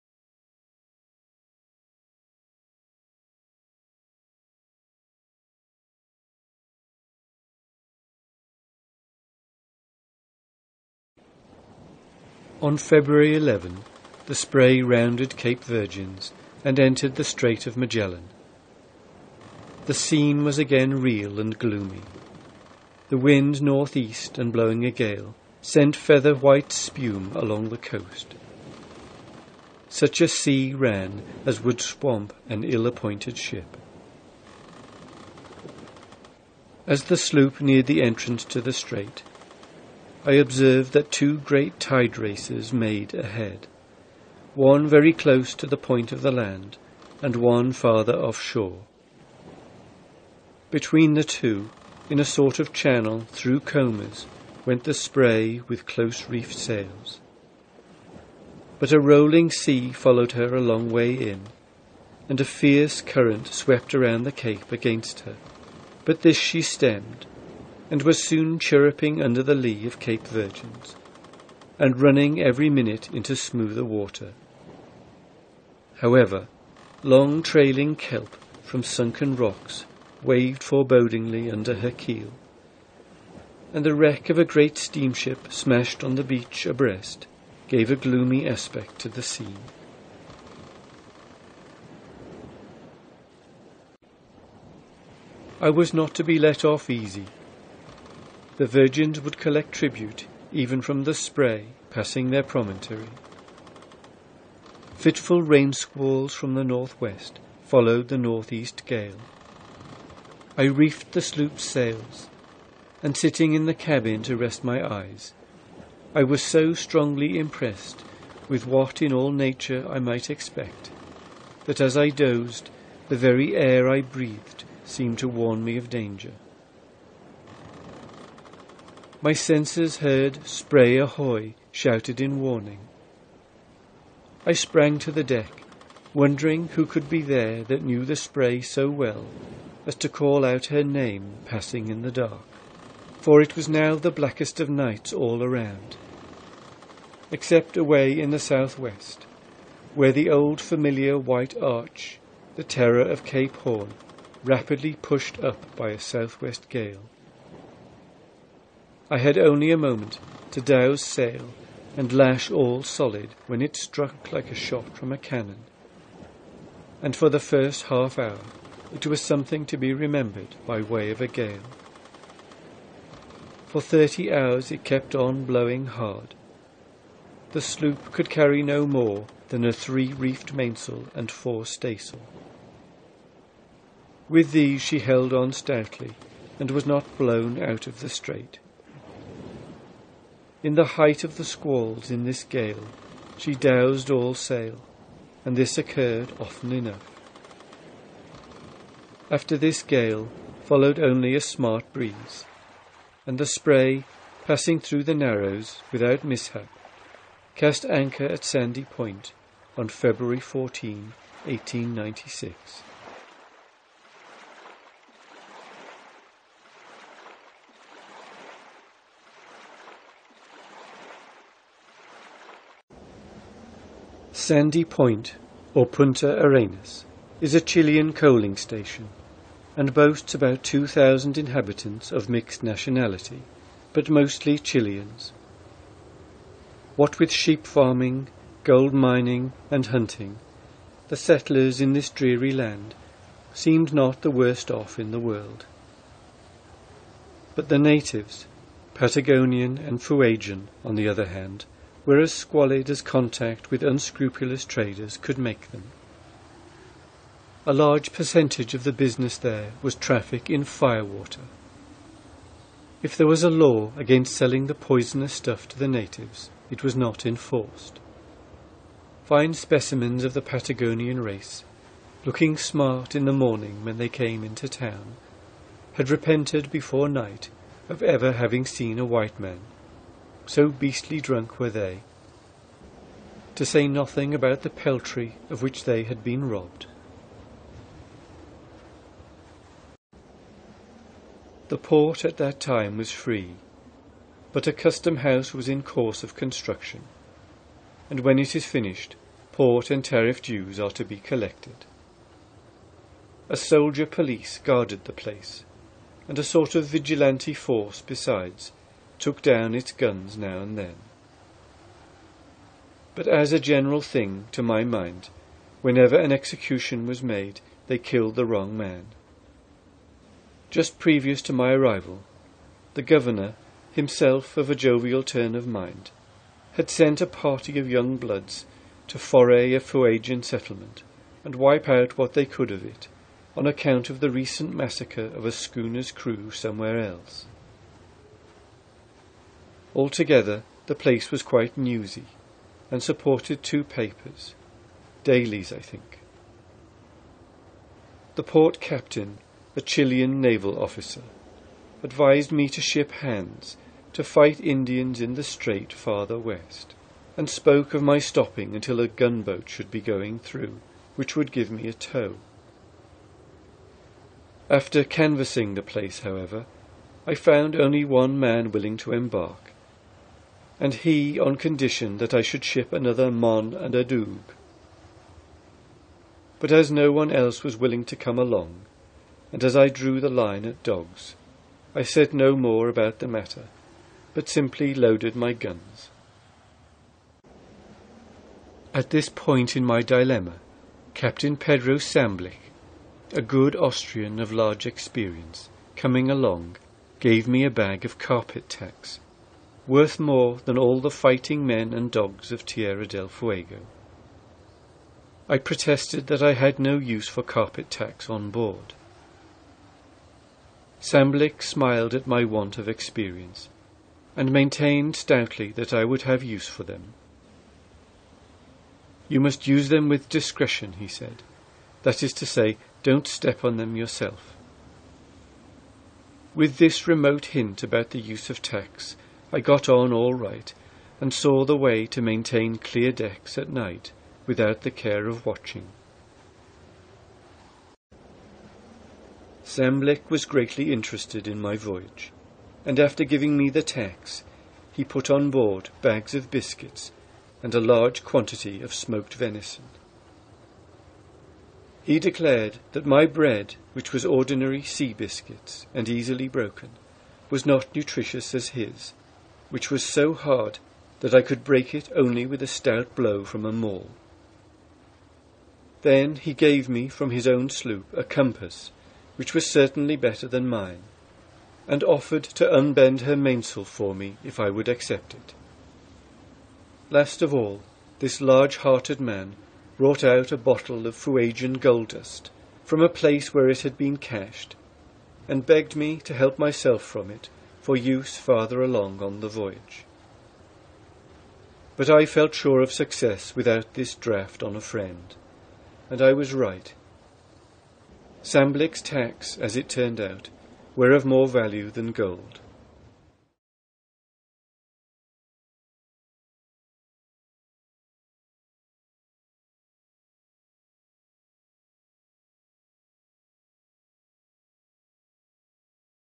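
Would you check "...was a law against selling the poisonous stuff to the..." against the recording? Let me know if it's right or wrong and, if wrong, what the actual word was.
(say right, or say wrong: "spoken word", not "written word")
right.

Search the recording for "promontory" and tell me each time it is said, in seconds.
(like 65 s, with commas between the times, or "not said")
102 s.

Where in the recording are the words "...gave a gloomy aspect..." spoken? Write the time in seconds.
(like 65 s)
87 s.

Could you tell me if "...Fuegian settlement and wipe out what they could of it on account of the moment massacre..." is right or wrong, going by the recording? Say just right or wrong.
wrong.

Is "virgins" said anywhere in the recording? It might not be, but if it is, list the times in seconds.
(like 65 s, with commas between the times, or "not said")
15 s, 70 s, 98 s.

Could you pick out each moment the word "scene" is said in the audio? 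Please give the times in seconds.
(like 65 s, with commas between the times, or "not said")
19 s, 89 s.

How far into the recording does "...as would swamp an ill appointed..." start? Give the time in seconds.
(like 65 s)
31 s.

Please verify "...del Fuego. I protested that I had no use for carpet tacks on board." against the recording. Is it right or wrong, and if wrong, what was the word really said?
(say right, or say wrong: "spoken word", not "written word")
right.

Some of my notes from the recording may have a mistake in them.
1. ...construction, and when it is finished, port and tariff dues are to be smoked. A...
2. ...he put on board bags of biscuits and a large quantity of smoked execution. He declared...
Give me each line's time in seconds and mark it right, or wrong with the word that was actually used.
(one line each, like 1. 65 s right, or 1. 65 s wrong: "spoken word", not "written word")
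1. 296 s wrong: "collected", not "smoked"
2. 444 s wrong: "venison", not "execution".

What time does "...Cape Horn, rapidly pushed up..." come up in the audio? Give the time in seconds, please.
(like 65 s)
153 s.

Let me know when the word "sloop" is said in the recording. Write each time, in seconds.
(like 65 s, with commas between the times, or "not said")
37 s, 111 s, 177 s, 467 s.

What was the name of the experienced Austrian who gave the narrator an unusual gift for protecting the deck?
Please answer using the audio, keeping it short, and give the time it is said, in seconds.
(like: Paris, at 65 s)
Pedro Samblich, at 391 s.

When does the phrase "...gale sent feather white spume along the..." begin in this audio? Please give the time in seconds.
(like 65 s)
24 s.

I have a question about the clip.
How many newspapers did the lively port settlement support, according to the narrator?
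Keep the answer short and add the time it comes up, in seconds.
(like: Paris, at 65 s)
2, at 343 s.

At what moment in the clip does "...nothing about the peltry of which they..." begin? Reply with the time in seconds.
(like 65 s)
283 s.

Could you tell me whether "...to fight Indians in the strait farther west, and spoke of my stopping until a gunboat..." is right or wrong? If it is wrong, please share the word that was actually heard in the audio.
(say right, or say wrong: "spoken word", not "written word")
right.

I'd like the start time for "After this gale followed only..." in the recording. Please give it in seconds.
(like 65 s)
199 s.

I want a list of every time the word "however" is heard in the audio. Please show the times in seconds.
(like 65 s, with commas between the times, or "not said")
75 s, 366 s.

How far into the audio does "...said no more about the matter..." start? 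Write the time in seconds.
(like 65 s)
382 s.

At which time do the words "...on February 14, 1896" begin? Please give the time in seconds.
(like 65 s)
209 s.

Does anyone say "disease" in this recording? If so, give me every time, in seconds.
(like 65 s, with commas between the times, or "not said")
not said.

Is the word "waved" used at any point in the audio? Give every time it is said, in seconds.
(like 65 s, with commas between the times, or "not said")
80 s.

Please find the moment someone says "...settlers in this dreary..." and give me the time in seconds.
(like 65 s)
241 s.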